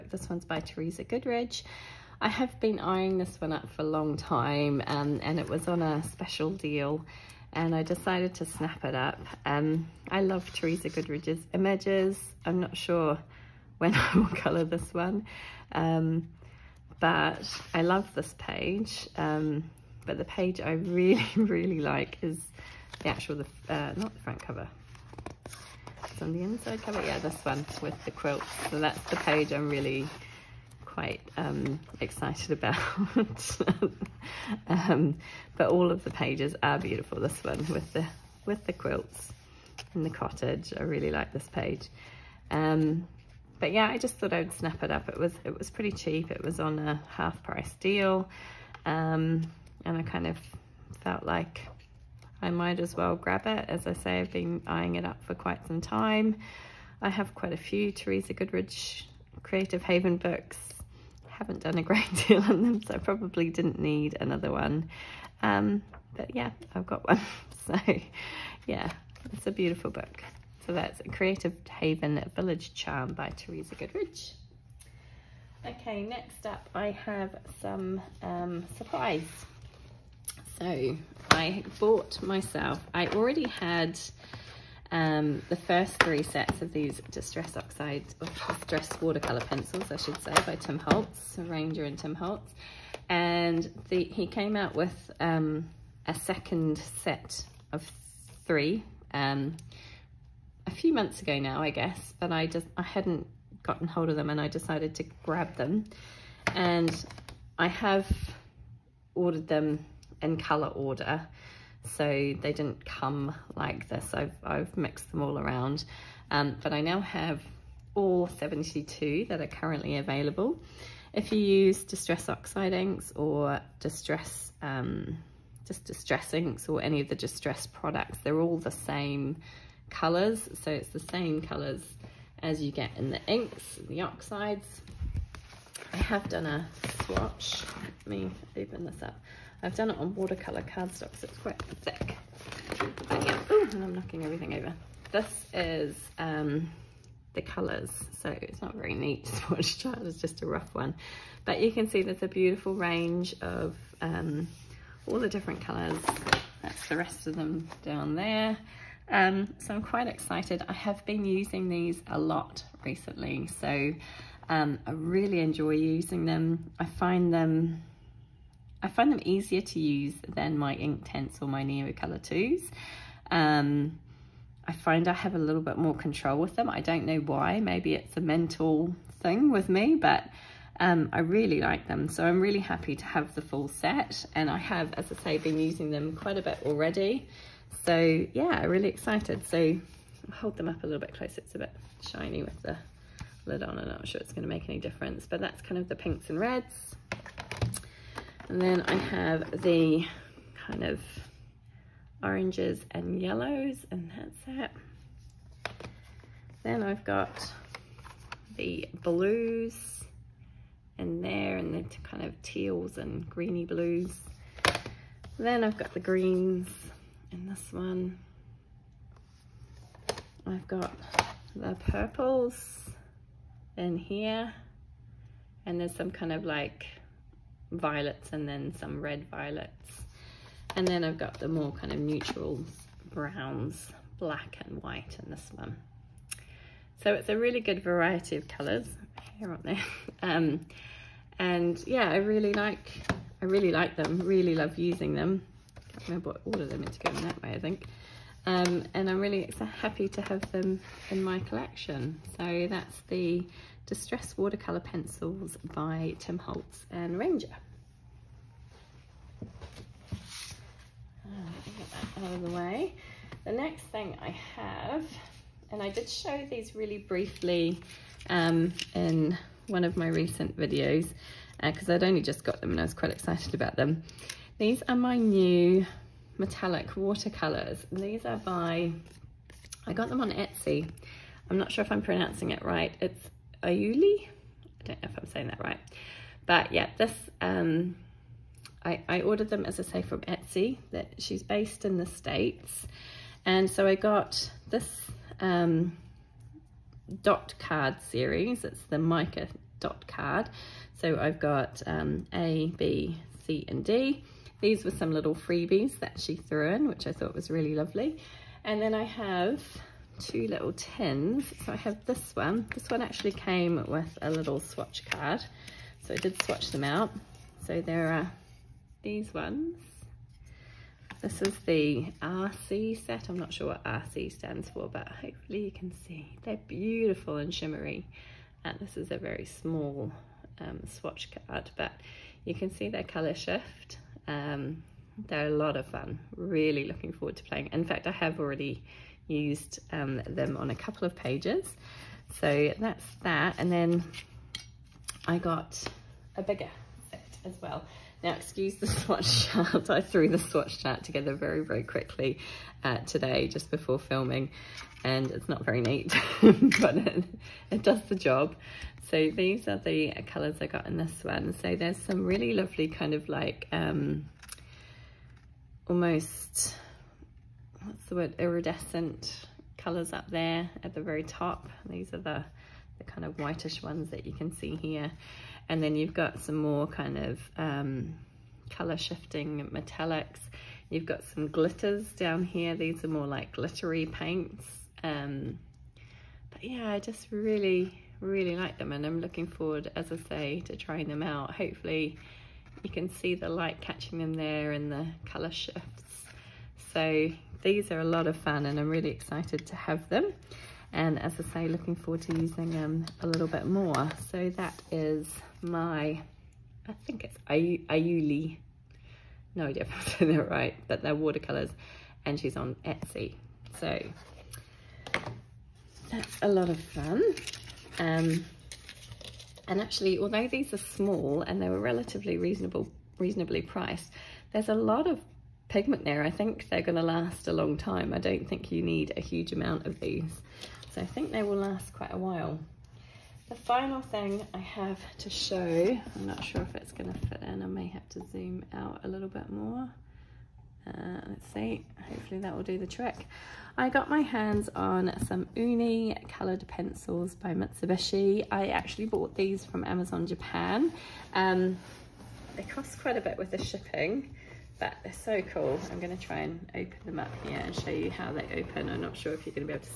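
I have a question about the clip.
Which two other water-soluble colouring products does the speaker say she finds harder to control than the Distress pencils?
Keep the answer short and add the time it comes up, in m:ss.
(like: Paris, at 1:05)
Inktense and Neocolor 2, at 2:50.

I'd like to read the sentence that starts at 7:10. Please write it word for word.
So I think they will last quite a while.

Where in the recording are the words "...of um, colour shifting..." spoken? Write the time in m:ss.
6:17.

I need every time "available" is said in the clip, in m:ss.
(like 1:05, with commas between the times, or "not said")
1:59.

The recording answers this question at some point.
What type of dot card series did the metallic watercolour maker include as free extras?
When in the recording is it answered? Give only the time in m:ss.
4:58.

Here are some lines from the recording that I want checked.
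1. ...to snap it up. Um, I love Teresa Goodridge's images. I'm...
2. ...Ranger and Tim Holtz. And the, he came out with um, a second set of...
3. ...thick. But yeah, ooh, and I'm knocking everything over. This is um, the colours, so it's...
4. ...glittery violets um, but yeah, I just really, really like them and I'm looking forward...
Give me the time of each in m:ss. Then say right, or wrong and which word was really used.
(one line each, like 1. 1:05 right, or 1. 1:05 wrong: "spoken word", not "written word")
1. 0:08 right
2. 1:31 right
3. 2:21 right
4. 6:23 wrong: "paints", not "violets".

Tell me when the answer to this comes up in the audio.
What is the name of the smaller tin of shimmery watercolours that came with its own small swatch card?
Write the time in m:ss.
5:22.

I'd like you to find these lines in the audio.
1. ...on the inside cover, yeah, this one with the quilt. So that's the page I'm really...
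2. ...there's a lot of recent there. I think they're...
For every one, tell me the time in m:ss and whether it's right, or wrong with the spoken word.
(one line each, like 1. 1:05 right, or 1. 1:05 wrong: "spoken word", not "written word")
1. 0:26 right
2. 7:04 wrong: "pigment", not "recent".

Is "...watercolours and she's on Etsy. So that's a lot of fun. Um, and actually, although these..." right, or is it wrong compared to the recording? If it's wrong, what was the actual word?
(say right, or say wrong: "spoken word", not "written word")
right.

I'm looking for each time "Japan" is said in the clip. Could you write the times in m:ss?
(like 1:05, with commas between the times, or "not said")
7:30.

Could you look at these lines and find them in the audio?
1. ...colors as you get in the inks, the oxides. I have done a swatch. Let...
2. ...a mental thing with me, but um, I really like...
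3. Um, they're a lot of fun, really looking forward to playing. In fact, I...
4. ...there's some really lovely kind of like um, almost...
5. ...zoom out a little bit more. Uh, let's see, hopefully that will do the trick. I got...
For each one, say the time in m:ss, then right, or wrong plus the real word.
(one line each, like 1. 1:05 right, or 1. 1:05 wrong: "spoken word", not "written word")
1. 2:11 right
2. 2:58 right
3. 5:34 right
4. 6:01 right
5. 7:18 right.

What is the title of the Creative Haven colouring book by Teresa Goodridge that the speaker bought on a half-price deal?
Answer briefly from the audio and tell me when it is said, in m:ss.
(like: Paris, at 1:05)
Village Charm, at 1:12.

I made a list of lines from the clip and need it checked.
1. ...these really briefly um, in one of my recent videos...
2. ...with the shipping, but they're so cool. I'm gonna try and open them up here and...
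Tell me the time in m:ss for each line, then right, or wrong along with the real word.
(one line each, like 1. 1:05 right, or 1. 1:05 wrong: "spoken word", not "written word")
1. 4:26 right
2. 7:33 right.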